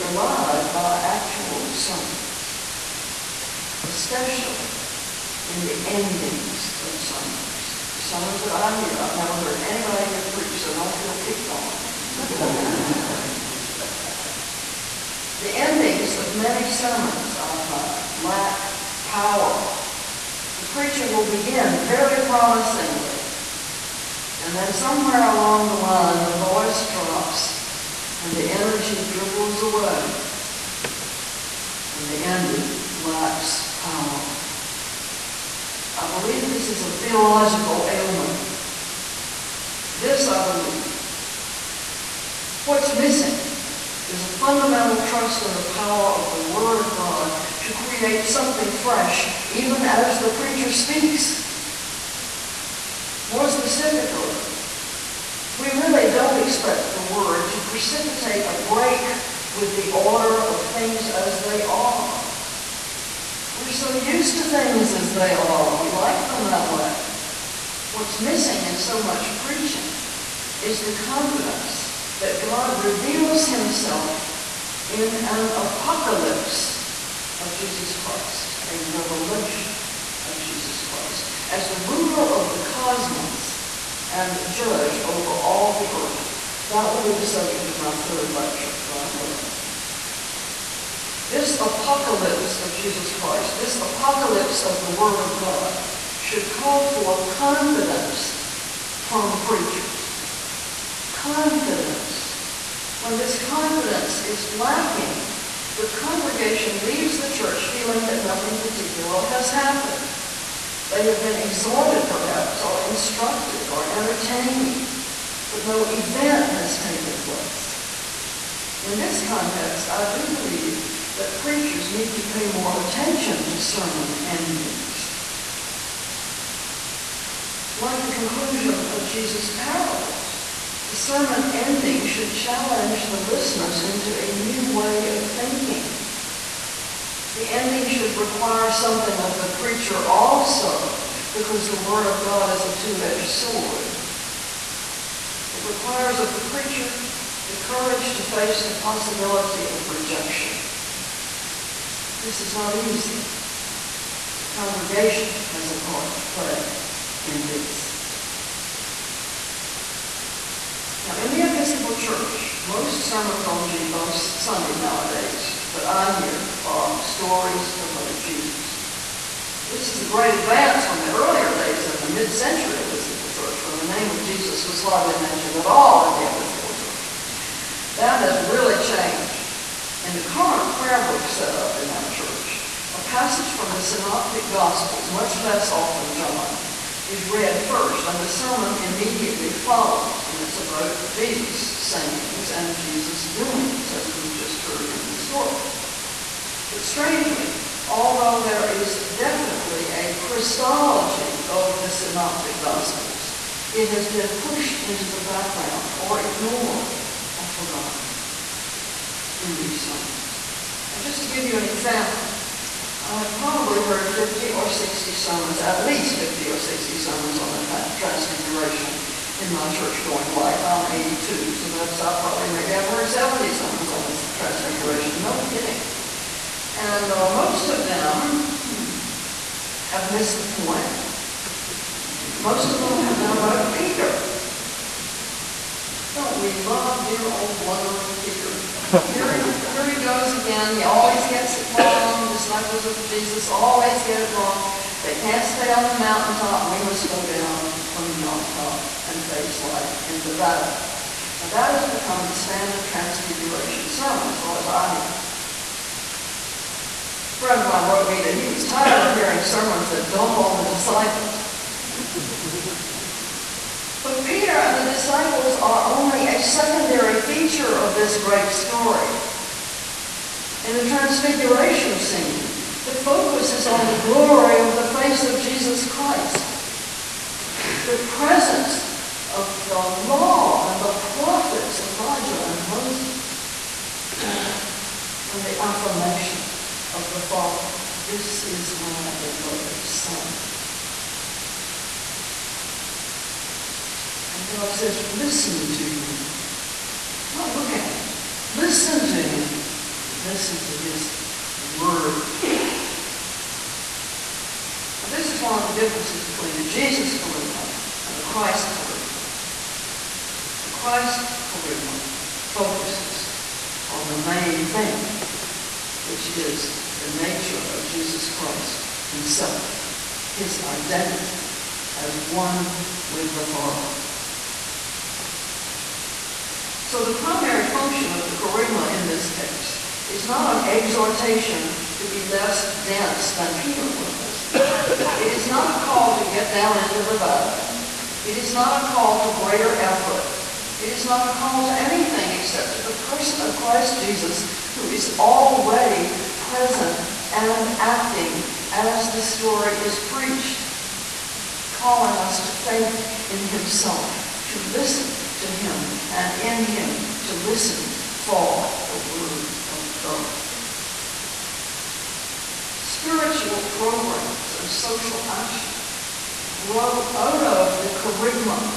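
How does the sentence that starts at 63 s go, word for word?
We're so used to things as they are.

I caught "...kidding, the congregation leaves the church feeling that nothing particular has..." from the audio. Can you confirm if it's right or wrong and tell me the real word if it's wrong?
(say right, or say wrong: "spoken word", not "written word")
wrong: "lacking", not "kidding".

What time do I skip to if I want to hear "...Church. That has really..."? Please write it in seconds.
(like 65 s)
176 s.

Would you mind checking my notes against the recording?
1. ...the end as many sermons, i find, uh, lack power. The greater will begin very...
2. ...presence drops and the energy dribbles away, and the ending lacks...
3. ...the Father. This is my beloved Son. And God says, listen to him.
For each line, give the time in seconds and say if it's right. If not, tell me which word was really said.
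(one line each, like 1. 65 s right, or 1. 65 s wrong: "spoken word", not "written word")
1. 15 s wrong: "preacher", not "greater"
2. 26 s wrong: "voice", not "presence"
3. 287 s right.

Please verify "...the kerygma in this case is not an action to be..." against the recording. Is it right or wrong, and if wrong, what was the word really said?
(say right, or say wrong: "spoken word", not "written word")
wrong: "exhortation", not "action".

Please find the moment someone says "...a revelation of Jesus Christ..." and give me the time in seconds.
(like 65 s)
78 s.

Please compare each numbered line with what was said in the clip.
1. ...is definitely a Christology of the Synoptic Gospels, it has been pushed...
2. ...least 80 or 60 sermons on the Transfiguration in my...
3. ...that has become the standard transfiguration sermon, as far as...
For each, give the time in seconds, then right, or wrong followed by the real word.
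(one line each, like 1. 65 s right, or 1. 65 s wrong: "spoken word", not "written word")
1. 198 s right
2. 215 s wrong: "50", not "80"
3. 251 s right.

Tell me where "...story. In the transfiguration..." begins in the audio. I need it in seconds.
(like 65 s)
268 s.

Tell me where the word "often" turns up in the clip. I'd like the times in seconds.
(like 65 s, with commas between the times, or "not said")
185 s.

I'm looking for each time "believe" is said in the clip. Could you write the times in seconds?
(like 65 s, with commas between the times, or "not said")
36 s, 40 s, 120 s.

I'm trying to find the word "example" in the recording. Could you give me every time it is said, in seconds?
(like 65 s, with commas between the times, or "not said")
211 s.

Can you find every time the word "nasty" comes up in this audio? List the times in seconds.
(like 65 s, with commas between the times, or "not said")
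not said.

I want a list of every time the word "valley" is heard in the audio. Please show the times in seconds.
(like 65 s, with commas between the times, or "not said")
250 s, 337 s.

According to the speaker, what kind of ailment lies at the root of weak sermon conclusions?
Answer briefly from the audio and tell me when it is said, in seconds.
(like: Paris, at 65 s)
Theological, at 36 s.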